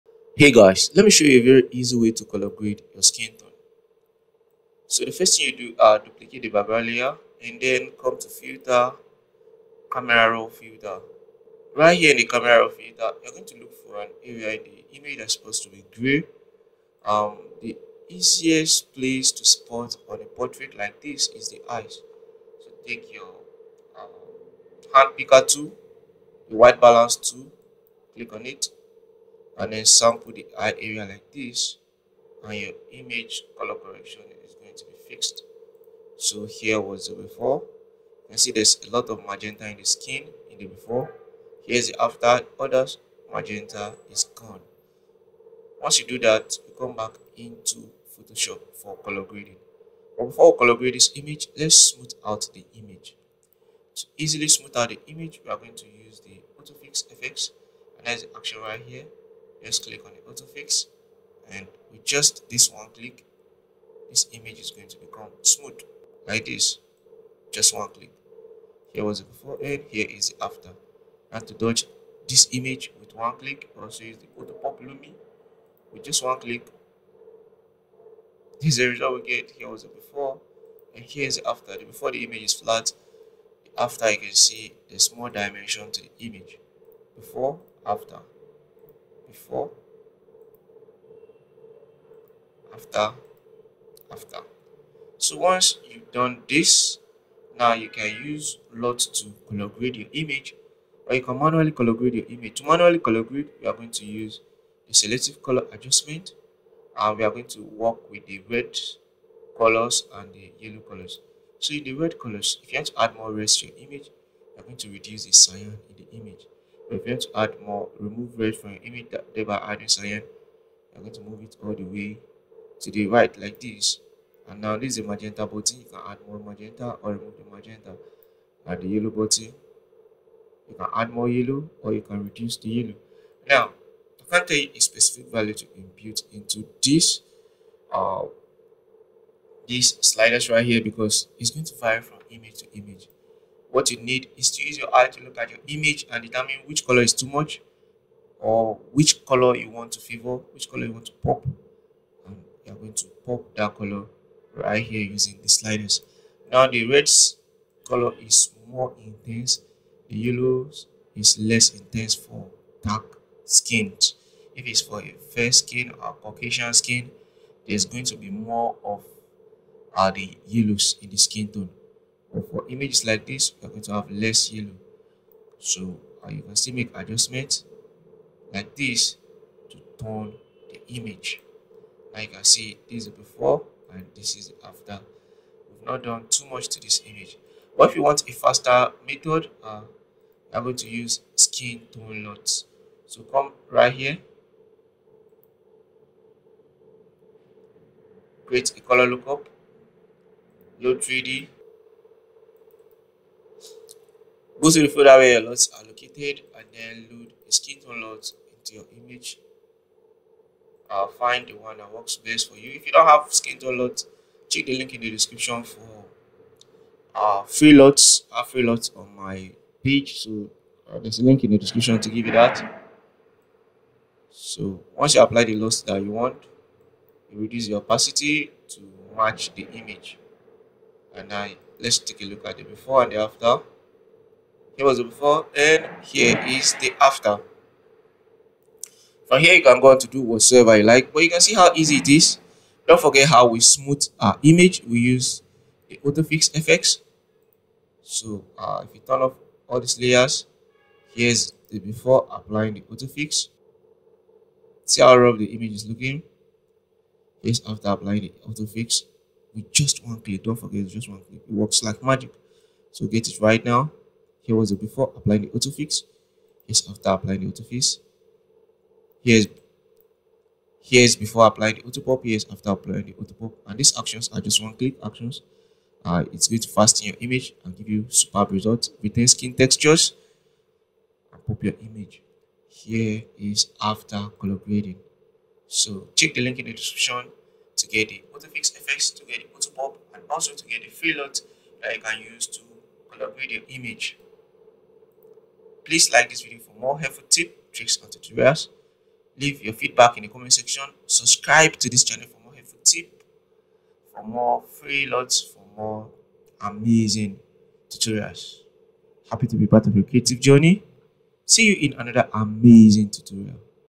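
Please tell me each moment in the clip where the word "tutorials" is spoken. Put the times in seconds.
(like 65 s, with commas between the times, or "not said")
298 s, 307 s, 313 s.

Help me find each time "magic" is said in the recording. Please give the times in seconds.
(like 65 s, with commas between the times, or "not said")
262 s.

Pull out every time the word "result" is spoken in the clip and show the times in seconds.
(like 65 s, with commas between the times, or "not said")
78 s, 278 s.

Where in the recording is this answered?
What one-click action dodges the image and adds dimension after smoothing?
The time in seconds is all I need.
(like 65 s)
74 s.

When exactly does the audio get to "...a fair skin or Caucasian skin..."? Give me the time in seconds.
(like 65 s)
165 s.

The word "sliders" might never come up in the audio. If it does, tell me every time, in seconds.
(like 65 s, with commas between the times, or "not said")
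140 s, 155 s.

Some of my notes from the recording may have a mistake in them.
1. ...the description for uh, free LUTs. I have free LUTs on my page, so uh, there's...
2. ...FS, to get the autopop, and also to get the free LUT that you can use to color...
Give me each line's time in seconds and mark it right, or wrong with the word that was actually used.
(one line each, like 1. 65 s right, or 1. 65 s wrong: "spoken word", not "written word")
1. 215 s right
2. 288 s right.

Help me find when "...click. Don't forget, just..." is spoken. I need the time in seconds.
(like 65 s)
260 s.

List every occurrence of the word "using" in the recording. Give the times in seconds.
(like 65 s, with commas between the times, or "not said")
155 s.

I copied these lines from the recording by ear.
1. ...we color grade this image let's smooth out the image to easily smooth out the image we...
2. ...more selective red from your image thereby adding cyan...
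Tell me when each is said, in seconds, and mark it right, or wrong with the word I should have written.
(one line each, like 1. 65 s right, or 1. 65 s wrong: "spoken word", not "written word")
1. 50 s right
2. 117 s wrong: "remove", not "selective".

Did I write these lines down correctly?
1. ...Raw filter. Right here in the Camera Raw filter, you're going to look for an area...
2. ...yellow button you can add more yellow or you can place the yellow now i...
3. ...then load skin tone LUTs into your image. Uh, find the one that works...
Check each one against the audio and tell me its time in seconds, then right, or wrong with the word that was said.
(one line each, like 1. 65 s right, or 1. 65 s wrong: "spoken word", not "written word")
1. 10 s right
2. 128 s wrong: "reduce", not "place"
3. 206 s right.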